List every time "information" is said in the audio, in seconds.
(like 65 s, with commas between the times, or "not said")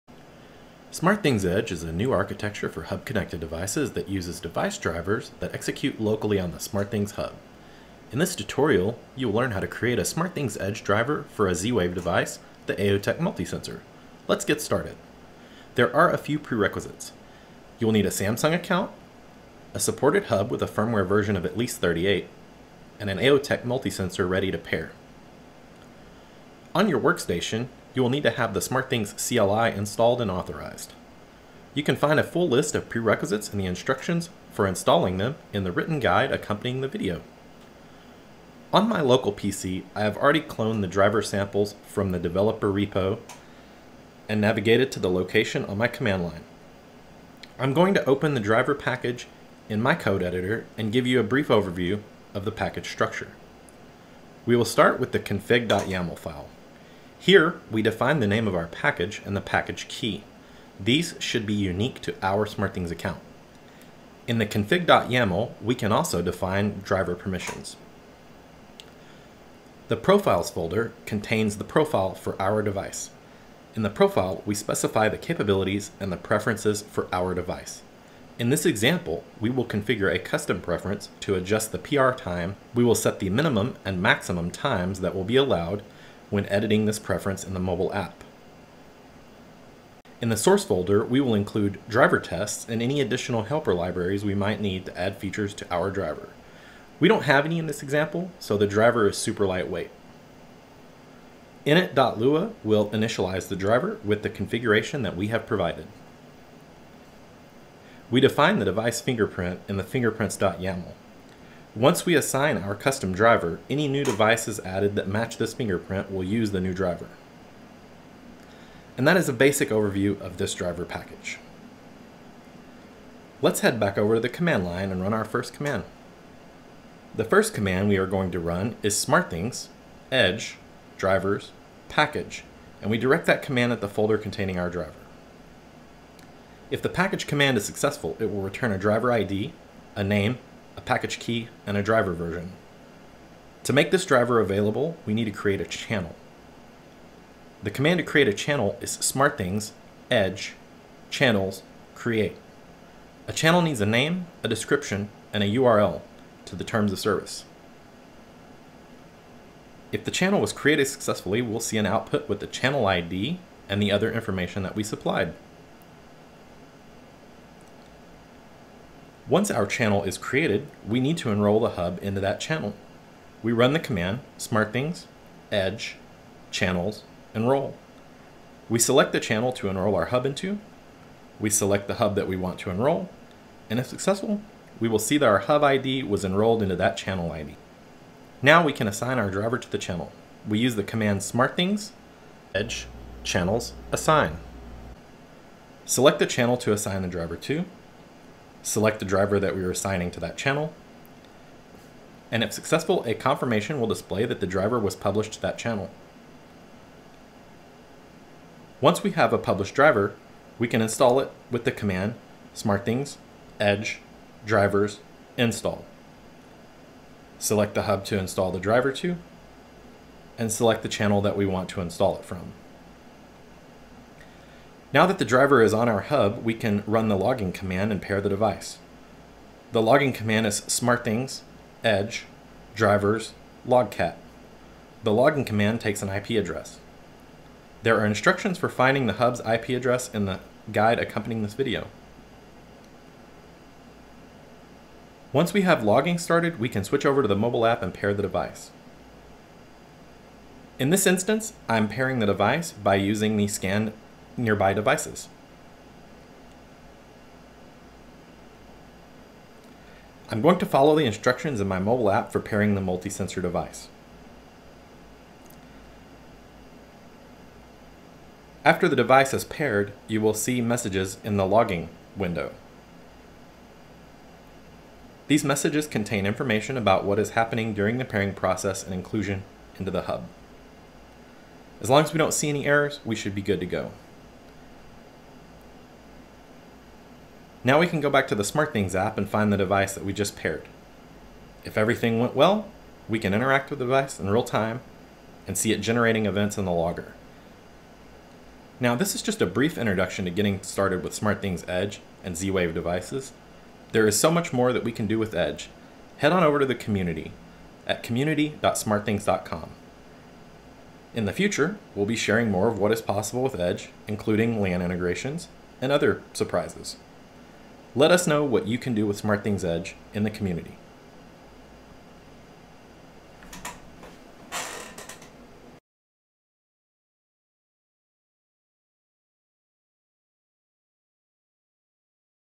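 164 s, 276 s.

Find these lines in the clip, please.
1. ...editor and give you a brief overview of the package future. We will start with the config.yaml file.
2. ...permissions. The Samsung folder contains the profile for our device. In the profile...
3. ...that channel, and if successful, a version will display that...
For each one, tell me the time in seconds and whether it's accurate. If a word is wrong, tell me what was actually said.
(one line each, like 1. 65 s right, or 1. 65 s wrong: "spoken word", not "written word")
1. 50 s wrong: "structure", not "future"
2. 67 s wrong: "Profiles", not "Samsung"
3. 200 s wrong: "confirmation", not "version".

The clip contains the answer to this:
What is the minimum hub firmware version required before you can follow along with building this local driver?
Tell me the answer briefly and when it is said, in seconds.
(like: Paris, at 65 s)
38, at 21 s.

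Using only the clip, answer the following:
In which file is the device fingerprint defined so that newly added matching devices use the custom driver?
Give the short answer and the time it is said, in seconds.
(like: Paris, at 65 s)
fingerprints.yaml, at 109 s.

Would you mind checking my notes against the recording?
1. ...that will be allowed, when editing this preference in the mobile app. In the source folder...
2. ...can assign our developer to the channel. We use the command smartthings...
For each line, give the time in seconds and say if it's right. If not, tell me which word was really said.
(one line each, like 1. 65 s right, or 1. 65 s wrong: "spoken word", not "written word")
1. 85 s right
2. 188 s wrong: "driver", not "developer".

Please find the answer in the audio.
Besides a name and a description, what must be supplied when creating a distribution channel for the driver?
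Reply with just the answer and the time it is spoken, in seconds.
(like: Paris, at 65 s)
URL to the terms of service, at 155 s.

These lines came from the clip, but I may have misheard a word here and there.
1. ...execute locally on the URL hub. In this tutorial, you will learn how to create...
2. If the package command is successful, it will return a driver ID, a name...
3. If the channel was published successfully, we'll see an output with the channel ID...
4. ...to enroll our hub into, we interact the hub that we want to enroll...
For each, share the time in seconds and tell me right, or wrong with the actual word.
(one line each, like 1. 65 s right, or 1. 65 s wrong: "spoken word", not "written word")
1. 5 s wrong: "SmartThings", not "URL"
2. 136 s right
3. 159 s wrong: "created", not "published"
4. 179 s wrong: "select", not "interact".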